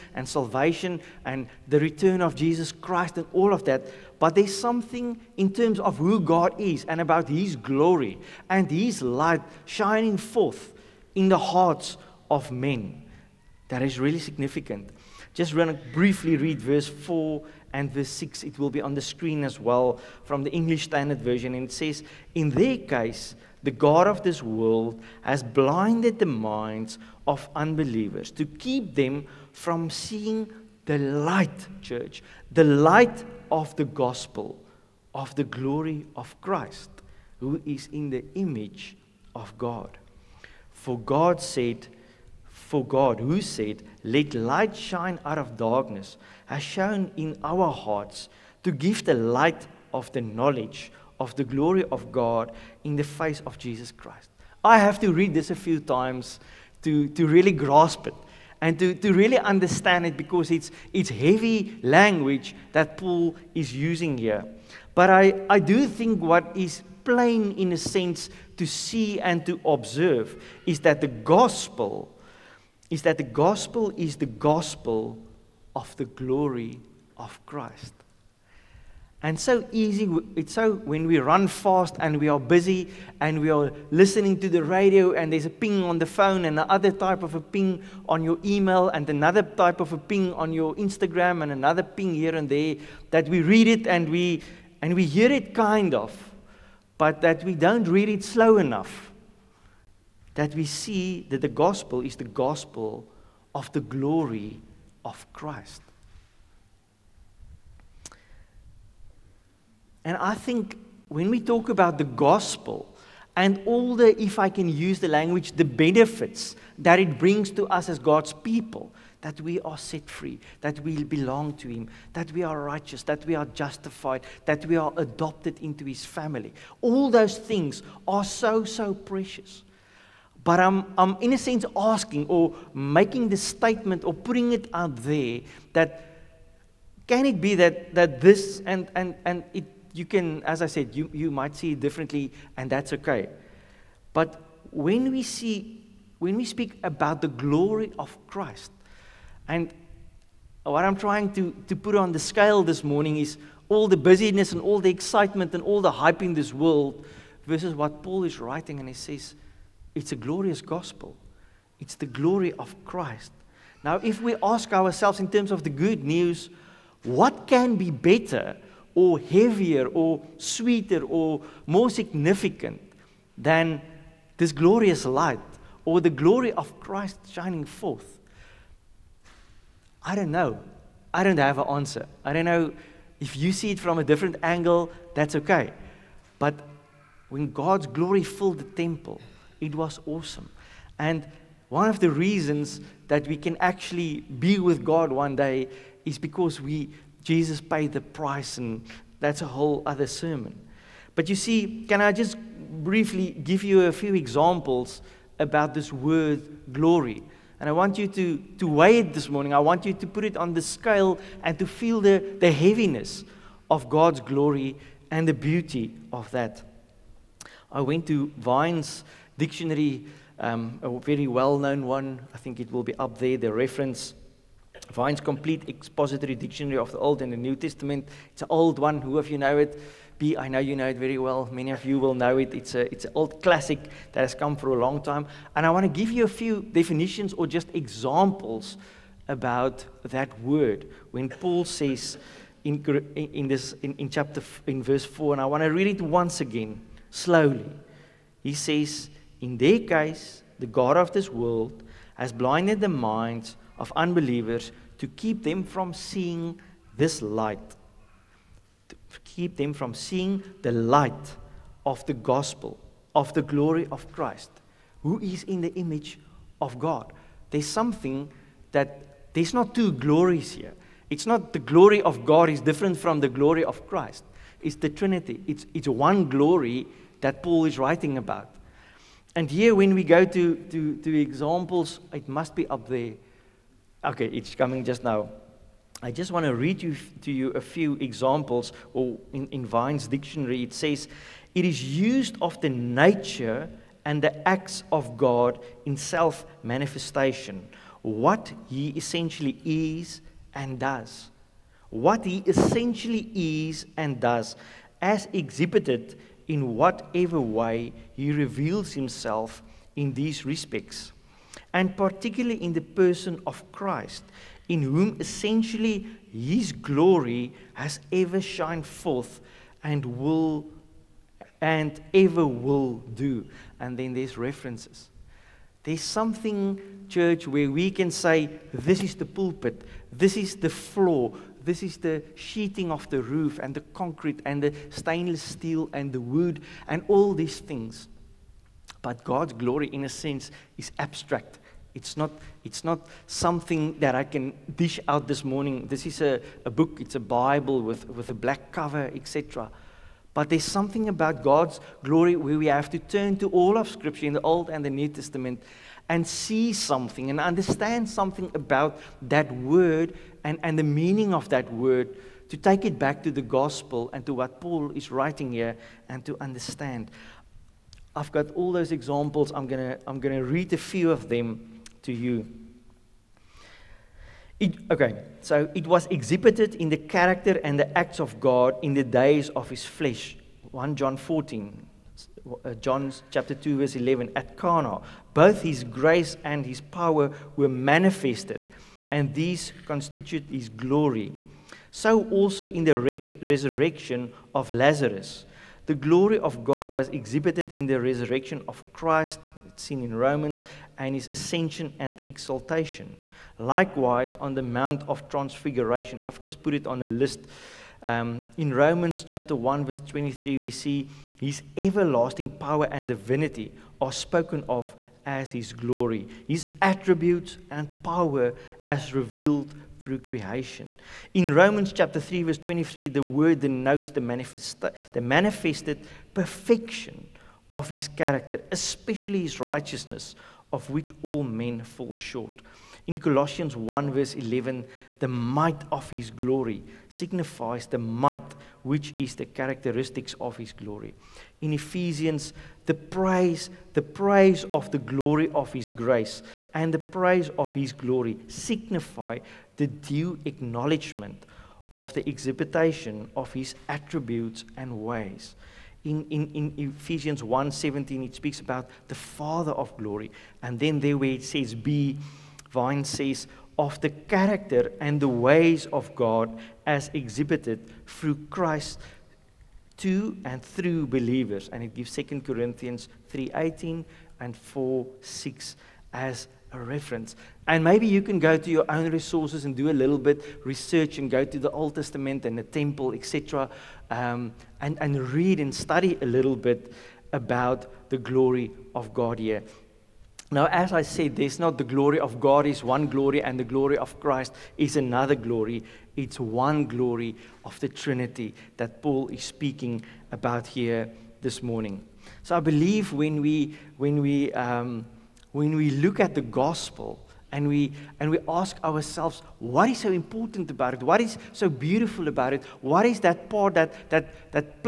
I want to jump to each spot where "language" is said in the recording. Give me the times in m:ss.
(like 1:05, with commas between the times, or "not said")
1:01, 1:55.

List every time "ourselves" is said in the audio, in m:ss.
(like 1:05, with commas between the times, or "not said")
2:44, 8:28.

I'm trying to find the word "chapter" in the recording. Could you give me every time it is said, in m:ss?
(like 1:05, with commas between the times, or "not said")
4:04, 6:23, 6:49, 7:01.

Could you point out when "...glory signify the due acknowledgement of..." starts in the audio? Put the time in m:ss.
7:27.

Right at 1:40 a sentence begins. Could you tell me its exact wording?
That we see that the gospel is the gospel of the glory of Christ.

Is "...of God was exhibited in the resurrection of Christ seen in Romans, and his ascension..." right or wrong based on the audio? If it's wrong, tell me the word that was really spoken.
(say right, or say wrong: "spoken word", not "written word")
right.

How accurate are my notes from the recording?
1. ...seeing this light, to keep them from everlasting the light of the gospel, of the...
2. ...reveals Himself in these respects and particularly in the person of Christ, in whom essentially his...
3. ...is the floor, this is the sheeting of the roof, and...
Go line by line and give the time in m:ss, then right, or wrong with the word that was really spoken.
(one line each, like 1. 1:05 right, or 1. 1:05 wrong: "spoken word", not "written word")
1. 4:15 wrong: "seeing", not "everlasting"
2. 5:08 right
3. 5:30 right.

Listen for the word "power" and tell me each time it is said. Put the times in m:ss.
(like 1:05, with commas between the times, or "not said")
6:26, 6:52, 6:58.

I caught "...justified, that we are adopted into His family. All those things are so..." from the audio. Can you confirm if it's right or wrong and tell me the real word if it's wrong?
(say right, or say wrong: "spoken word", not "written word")
right.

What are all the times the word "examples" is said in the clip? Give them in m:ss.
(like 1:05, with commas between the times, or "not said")
3:24, 3:57, 4:41, 4:47, 6:08.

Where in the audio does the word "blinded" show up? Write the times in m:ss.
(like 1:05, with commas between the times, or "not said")
0:25, 4:12.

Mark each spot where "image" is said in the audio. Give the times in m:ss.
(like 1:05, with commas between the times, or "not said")
0:38, 4:25.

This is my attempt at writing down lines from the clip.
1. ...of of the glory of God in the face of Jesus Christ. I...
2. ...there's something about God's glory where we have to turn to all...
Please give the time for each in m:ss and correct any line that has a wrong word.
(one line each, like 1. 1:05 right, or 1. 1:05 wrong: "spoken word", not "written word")
1. 0:50 right
2. 5:50 right.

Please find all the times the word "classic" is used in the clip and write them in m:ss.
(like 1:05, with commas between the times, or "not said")
3:53.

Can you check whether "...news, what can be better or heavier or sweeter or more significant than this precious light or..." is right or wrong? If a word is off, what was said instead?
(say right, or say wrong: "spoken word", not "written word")
wrong: "glorious", not "precious".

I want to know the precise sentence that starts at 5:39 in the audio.
But God's glory, in a sense, is abstract.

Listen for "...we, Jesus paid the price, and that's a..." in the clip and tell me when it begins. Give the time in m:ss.
3:16.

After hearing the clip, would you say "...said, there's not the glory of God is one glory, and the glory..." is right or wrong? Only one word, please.
right.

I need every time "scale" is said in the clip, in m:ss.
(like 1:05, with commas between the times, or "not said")
2:32, 3:30.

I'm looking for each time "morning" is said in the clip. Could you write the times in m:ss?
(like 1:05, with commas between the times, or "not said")
2:32, 3:29, 5:45, 8:21.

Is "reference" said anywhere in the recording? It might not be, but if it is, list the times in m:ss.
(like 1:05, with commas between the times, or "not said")
3:43, 5:24, 7:56.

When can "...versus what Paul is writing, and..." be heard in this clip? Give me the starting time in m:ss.
2:37.